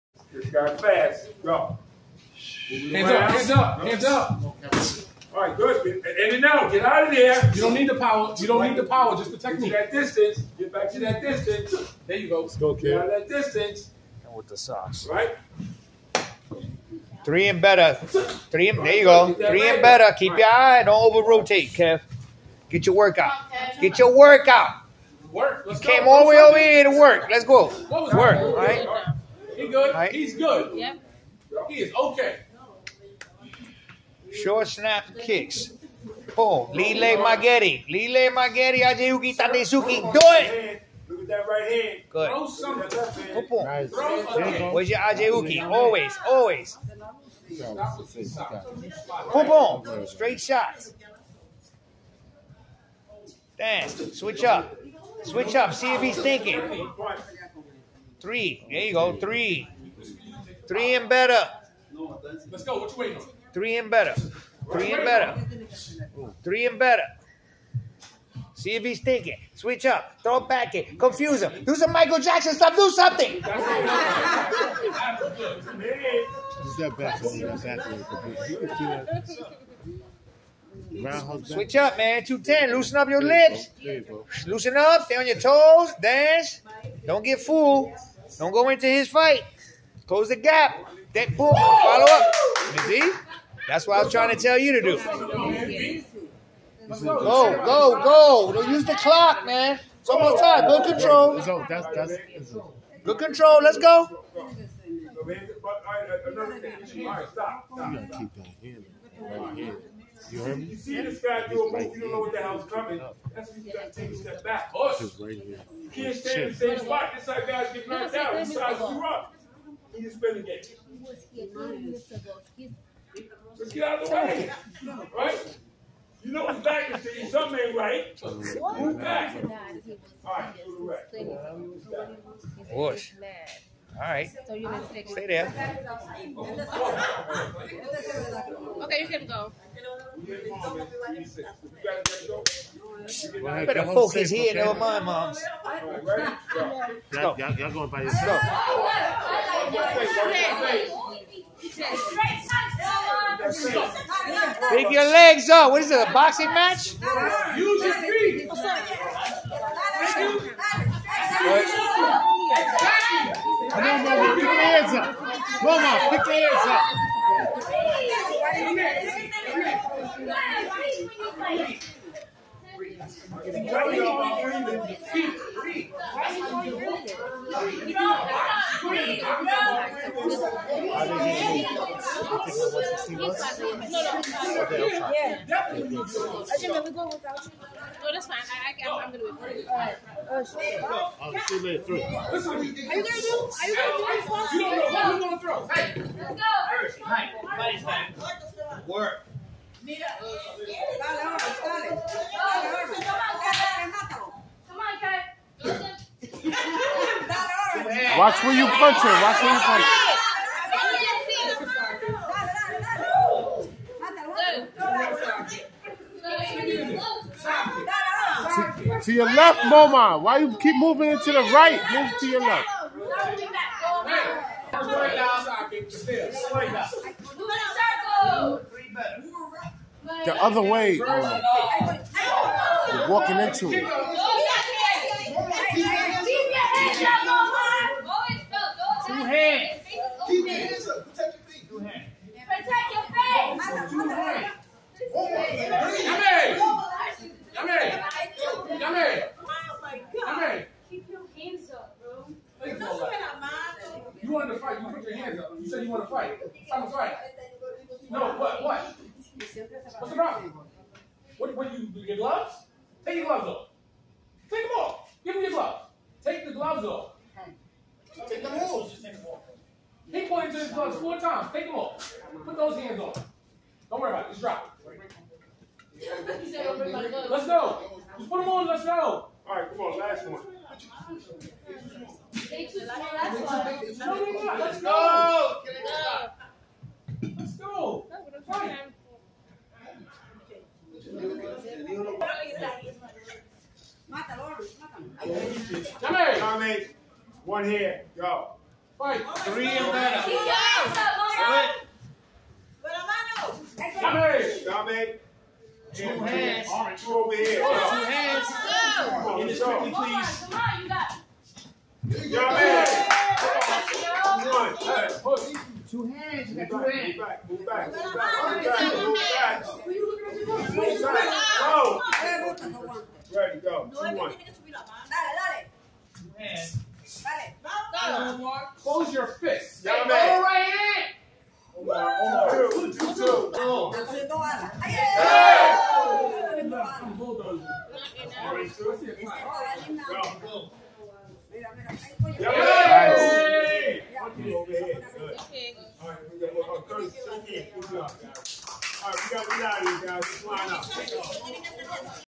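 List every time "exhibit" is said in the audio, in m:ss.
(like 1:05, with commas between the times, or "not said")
not said.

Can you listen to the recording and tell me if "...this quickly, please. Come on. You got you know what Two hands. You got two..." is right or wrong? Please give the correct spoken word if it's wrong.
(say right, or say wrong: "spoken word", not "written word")
right.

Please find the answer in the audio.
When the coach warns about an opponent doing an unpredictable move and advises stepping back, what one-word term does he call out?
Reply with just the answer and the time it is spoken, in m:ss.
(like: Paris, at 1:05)
Horse, at 1:54.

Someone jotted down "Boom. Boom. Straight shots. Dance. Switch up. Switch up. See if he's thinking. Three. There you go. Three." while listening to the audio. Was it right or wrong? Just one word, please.
right.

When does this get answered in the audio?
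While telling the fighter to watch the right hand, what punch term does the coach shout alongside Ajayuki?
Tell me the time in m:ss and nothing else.
0:39.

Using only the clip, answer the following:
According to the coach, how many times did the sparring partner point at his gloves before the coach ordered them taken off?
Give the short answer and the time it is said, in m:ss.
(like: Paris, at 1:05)
4, at 4:30.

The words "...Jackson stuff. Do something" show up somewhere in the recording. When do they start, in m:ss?
1:12.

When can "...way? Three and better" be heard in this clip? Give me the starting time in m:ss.
1:02.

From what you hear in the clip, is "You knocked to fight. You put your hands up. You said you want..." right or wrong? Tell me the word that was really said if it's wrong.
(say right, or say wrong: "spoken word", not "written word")
wrong: "wanted", not "knocked".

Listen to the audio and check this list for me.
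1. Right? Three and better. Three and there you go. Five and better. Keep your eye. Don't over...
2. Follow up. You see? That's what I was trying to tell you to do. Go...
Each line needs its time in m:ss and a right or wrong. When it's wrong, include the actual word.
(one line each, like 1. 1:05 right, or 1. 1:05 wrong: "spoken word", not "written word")
1. 0:15 wrong: "Three", not "Five"
2. 1:31 right.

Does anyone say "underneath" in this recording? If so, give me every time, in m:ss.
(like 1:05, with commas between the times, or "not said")
not said.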